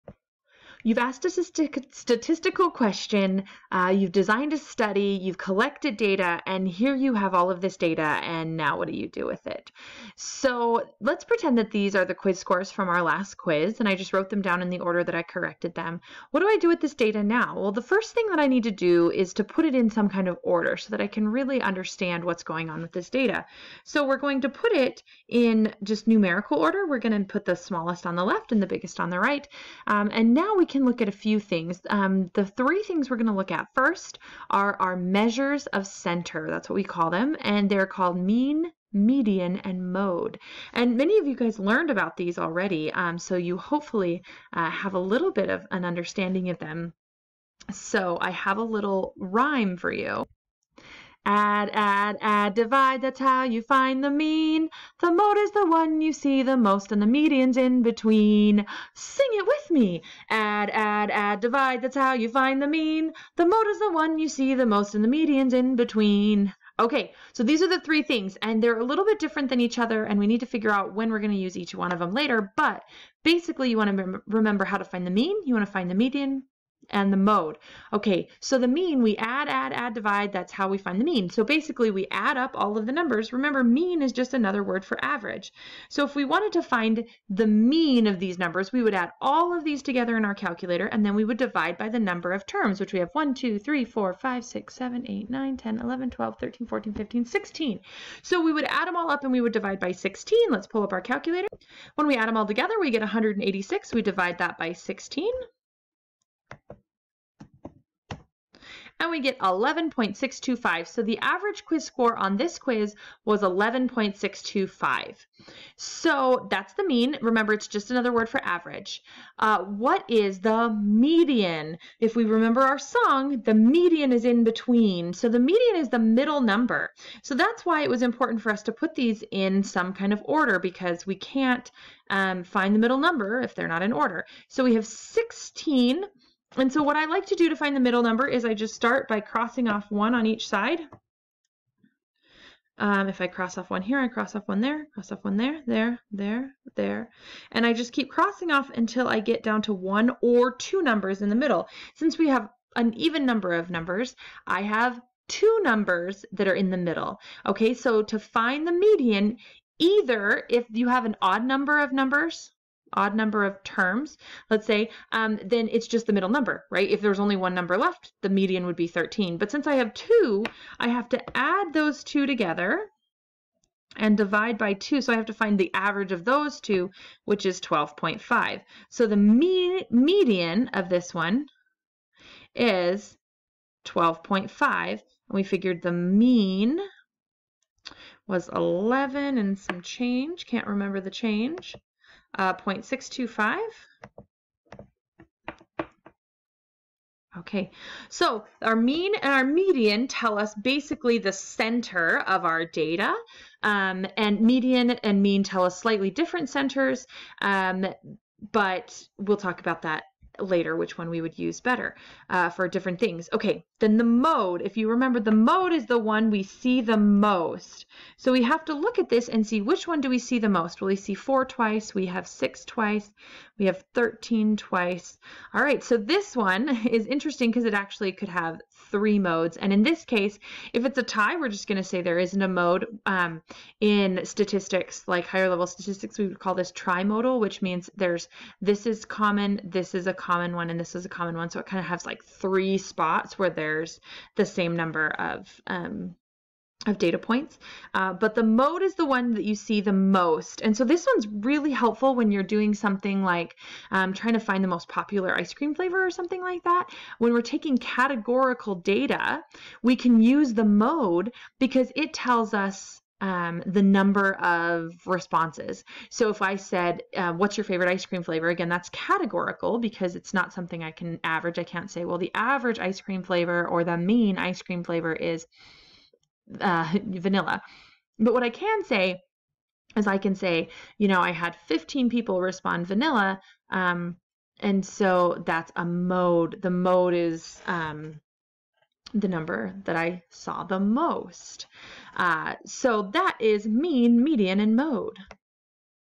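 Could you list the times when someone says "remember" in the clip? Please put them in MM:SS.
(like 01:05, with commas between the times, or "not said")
01:14, 01:23, 01:57, 02:02, 03:10, 03:34.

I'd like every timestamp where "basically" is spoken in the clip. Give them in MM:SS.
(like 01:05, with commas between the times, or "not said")
01:13, 01:21, 03:20.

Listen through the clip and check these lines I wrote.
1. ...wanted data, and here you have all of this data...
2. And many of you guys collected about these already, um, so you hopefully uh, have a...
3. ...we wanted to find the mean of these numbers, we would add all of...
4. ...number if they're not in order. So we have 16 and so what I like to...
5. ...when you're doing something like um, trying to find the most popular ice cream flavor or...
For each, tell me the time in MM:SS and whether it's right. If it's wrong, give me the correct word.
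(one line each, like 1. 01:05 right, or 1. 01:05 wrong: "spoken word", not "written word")
1. 00:05 wrong: "collected", not "wanted"
2. 00:40 wrong: "learned", not "collected"
3. 01:26 right
4. 02:12 right
5. 04:12 right.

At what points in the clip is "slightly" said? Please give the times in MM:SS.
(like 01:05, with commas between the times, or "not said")
03:25.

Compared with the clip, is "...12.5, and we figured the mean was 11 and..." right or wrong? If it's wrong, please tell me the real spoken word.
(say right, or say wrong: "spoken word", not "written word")
right.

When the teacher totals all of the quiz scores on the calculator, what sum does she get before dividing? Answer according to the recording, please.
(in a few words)
186.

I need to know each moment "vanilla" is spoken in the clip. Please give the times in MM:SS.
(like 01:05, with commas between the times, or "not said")
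04:37, 04:42.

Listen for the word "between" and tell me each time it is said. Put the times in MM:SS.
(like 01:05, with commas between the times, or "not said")
00:57, 01:05, 02:04.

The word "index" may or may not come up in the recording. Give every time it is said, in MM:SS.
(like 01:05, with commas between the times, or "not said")
not said.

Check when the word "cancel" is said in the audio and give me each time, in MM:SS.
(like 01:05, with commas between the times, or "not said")
not said.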